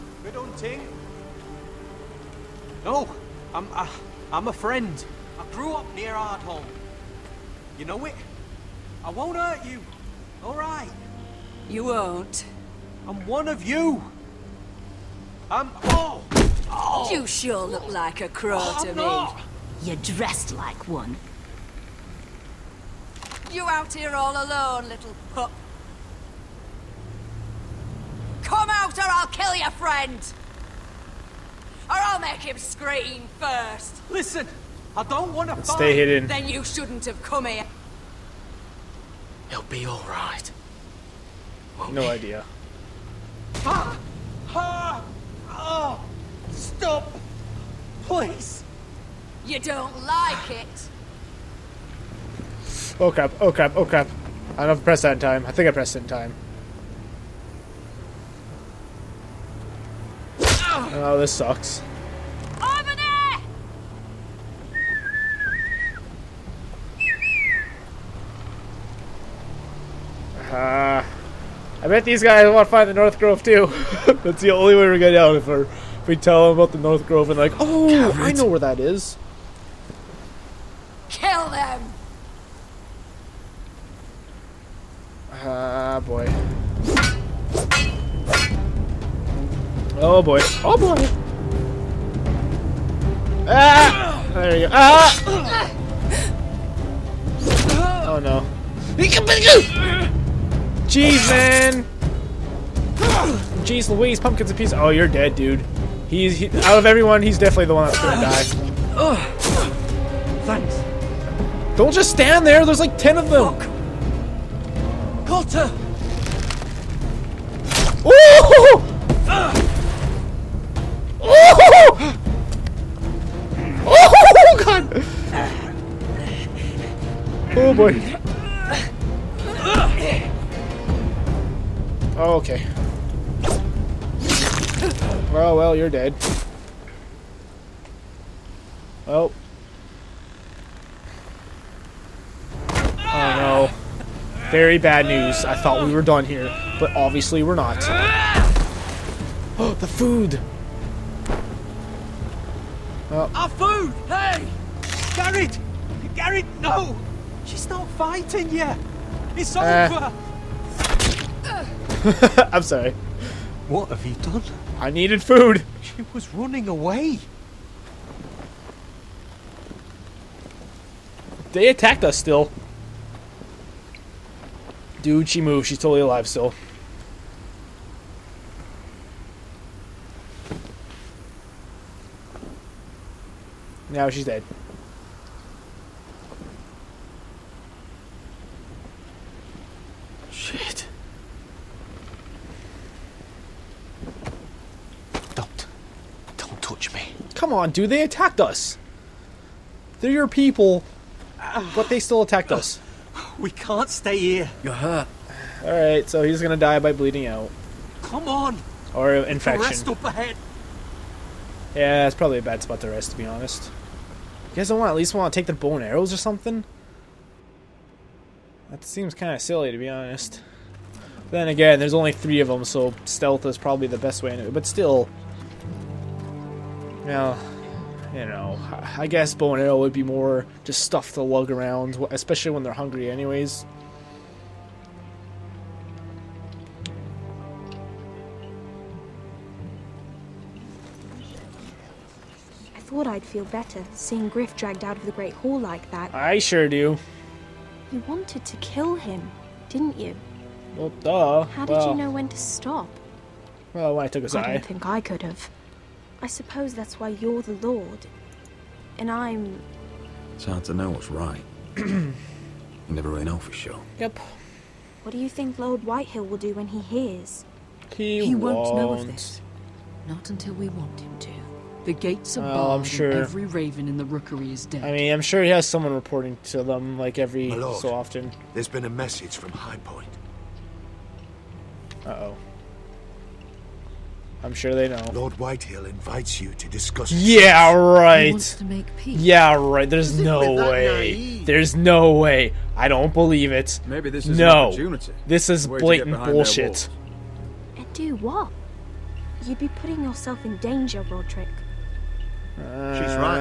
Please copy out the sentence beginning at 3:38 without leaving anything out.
That seems kind of silly, to be honest.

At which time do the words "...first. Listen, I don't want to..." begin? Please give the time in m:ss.
0:33.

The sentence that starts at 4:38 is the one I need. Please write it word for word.
There's been a message from High Point.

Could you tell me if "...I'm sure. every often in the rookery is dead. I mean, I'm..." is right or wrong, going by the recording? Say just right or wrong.
wrong.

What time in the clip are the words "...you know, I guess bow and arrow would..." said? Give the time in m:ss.
3:48.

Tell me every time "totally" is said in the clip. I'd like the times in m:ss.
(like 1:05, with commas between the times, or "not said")
2:55.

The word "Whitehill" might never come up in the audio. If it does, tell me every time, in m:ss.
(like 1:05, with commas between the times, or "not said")
4:25, 4:45.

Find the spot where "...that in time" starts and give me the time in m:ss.
0:55.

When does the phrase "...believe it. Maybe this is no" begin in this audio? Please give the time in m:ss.
4:53.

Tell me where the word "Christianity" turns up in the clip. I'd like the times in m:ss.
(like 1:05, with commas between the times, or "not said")
not said.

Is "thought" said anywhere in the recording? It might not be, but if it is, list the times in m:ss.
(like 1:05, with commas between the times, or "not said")
2:25, 4:02.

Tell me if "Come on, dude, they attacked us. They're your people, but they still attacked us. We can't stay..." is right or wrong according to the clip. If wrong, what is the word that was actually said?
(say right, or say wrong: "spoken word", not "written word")
right.